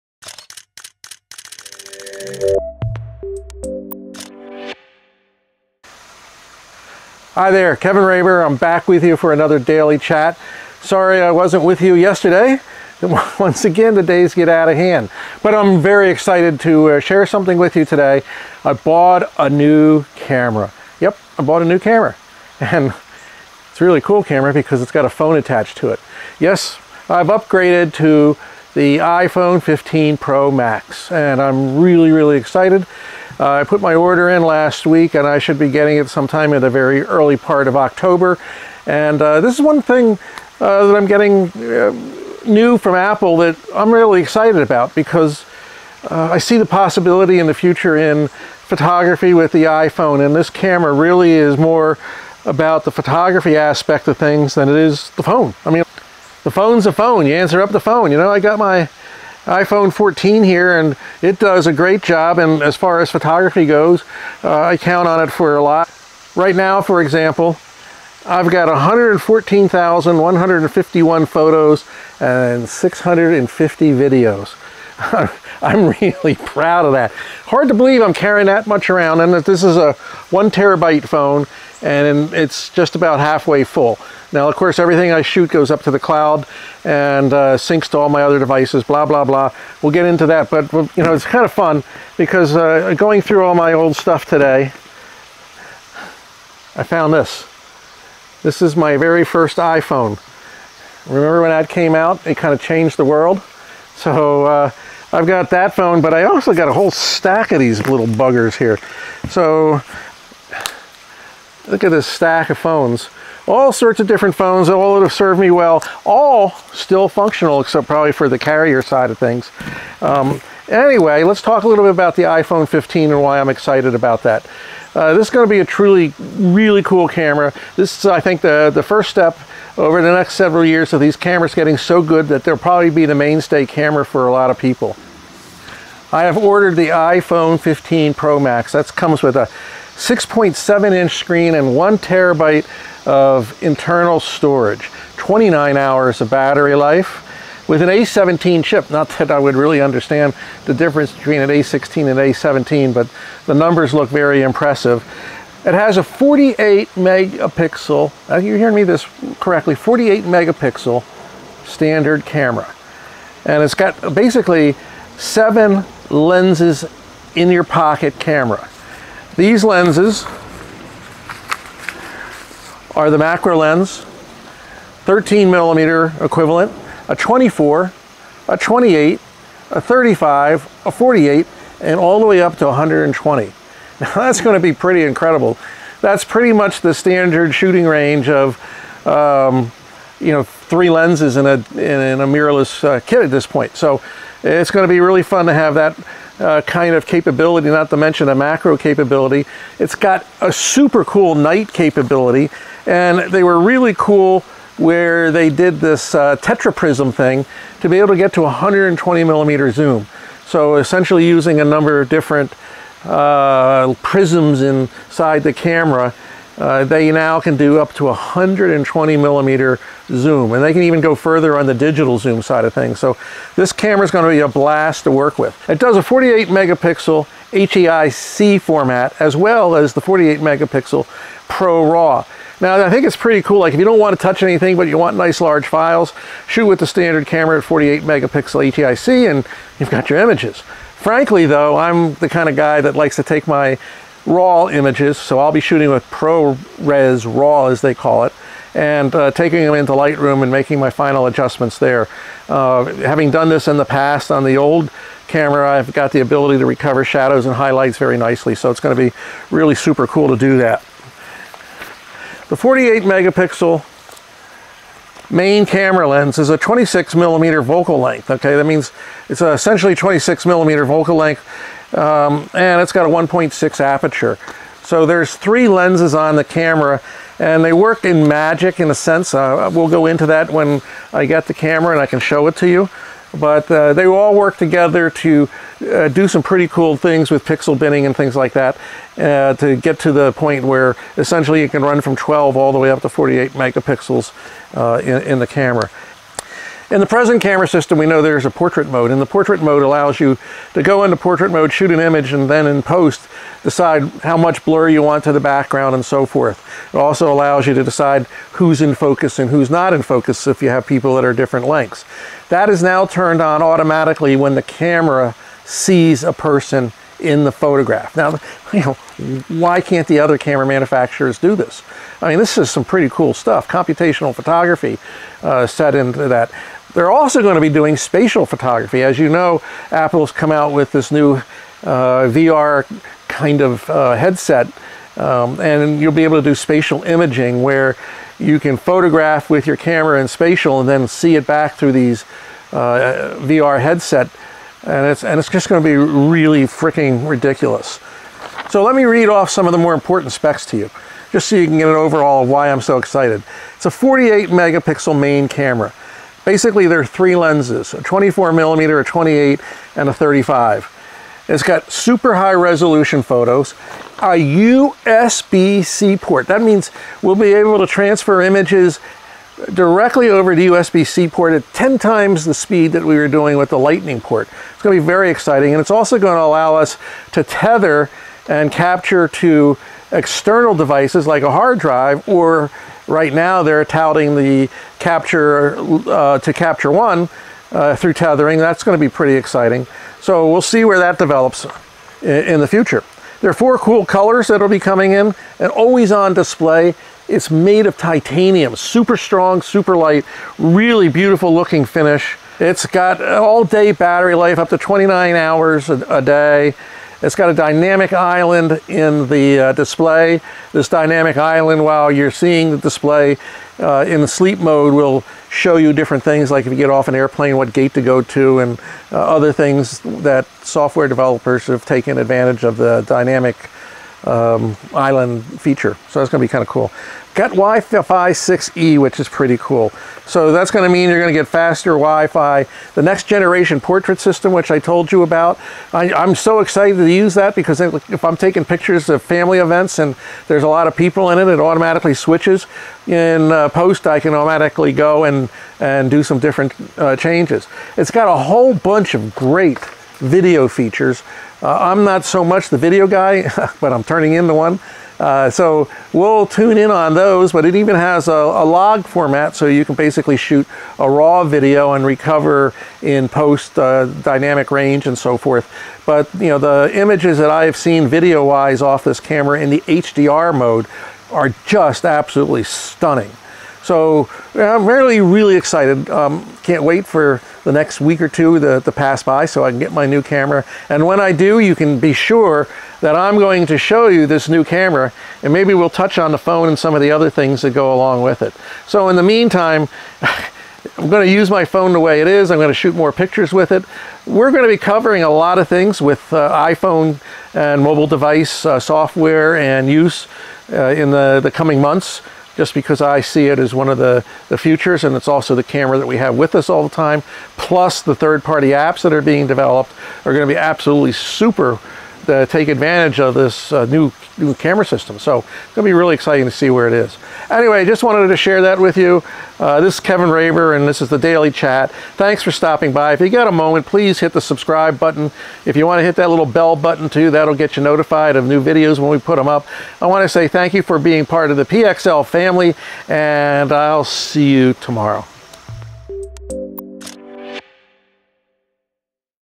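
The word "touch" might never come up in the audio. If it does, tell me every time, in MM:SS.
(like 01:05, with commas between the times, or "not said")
03:54, 08:05.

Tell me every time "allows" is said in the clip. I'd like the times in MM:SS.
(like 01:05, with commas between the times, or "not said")
04:59, 05:07, 06:16.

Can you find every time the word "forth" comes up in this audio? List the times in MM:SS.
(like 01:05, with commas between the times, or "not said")
05:06, 07:45.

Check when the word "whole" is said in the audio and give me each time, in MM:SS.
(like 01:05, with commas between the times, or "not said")
01:46, 07:28.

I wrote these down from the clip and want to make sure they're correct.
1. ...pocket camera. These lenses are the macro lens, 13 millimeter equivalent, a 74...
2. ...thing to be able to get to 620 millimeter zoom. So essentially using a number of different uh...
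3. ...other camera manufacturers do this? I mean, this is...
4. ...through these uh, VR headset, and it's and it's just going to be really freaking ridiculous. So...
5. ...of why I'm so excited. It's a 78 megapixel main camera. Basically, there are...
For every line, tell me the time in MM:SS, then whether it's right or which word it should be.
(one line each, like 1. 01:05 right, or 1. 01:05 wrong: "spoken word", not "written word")
1. 02:47 wrong: "24", not "74"
2. 03:27 wrong: "120", not "620"
3. 05:20 right
4. 05:41 right
5. 05:52 wrong: "48", not "78".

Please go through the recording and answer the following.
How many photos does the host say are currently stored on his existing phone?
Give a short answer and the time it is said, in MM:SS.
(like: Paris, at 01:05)
114,151, at 01:08.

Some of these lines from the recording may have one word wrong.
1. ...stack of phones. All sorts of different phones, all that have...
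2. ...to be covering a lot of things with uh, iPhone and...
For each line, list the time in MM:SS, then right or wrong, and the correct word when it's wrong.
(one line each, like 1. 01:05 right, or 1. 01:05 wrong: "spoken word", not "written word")
1. 01:52 right
2. 08:14 right.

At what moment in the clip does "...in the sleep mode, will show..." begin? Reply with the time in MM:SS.
06:54.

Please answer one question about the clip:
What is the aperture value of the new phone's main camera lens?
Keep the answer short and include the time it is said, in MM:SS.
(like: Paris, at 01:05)
1.6, at 04:33.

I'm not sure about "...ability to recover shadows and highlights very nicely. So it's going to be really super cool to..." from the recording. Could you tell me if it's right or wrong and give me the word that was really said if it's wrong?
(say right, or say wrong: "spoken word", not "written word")
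right.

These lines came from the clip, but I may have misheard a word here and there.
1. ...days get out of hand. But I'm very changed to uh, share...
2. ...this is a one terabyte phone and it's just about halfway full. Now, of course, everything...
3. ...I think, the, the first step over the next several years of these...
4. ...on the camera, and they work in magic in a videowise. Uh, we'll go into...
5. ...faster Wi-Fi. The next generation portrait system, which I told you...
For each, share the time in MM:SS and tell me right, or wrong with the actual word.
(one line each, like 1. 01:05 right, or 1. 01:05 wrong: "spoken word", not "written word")
1. 00:14 wrong: "excited", not "changed"
2. 01:19 right
3. 02:08 right
4. 04:36 wrong: "sense", not "videowise"
5. 07:11 right.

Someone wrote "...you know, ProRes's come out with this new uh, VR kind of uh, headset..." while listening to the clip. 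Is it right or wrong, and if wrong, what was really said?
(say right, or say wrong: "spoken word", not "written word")
wrong: "Apple", not "ProRes".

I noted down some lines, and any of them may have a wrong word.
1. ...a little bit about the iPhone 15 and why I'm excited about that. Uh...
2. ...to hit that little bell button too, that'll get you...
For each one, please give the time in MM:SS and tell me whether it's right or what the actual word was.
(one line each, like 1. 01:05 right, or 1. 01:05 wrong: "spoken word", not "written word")
1. 02:01 right
2. 08:45 right.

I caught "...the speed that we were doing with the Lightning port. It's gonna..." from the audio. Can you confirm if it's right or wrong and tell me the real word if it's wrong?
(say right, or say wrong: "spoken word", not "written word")
right.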